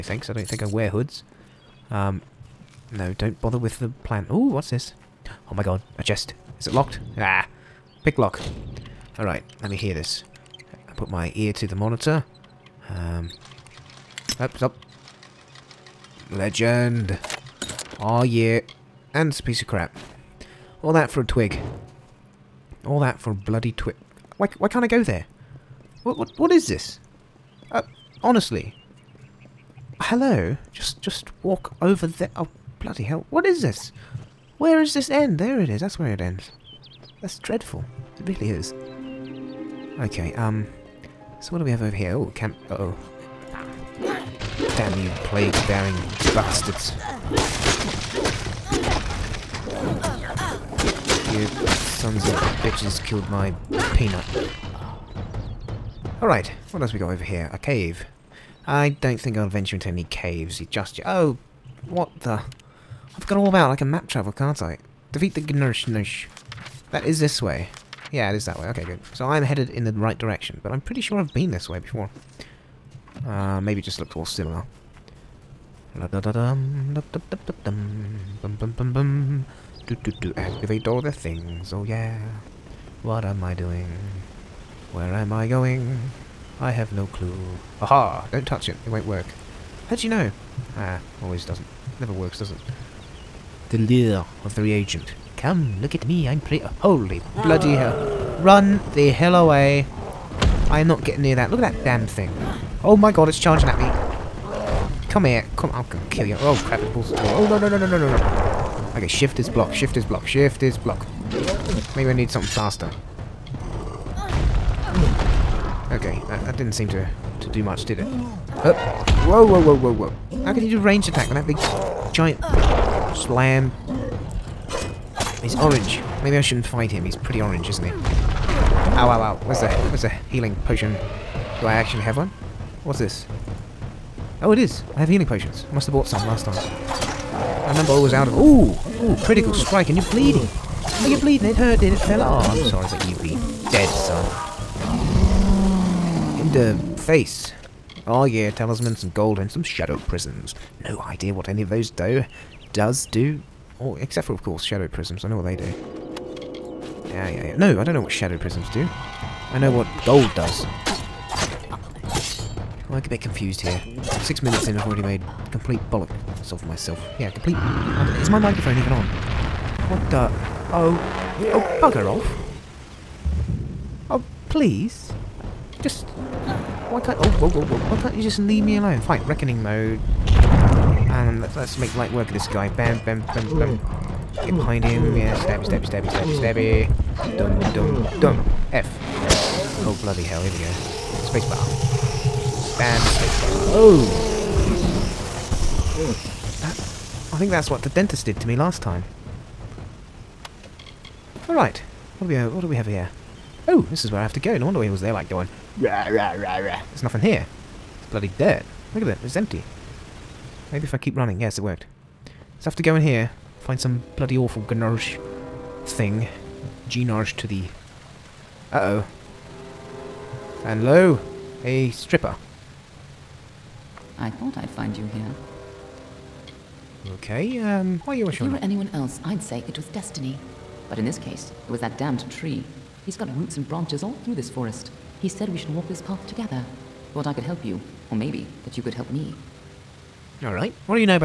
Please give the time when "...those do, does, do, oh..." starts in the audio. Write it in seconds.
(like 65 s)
151 s.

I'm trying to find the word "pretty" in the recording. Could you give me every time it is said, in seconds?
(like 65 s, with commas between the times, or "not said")
70 s, 96 s, 127 s.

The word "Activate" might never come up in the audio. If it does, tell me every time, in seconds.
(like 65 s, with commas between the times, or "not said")
80 s.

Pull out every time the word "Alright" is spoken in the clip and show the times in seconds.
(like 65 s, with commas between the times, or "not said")
9 s, 56 s, 201 s, 240 s.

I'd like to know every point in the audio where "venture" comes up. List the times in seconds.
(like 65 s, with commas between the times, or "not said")
59 s.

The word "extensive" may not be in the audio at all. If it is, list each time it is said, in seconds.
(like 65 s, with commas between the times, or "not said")
not said.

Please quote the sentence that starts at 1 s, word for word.
Um, no, don't bother with the plant.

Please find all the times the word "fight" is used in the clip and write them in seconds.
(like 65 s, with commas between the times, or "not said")
126 s.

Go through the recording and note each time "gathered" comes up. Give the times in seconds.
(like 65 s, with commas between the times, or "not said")
not said.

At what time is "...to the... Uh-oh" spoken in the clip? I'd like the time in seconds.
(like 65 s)
217 s.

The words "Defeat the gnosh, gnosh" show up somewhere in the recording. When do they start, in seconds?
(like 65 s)
65 s.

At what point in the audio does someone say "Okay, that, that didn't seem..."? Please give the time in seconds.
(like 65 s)
115 s.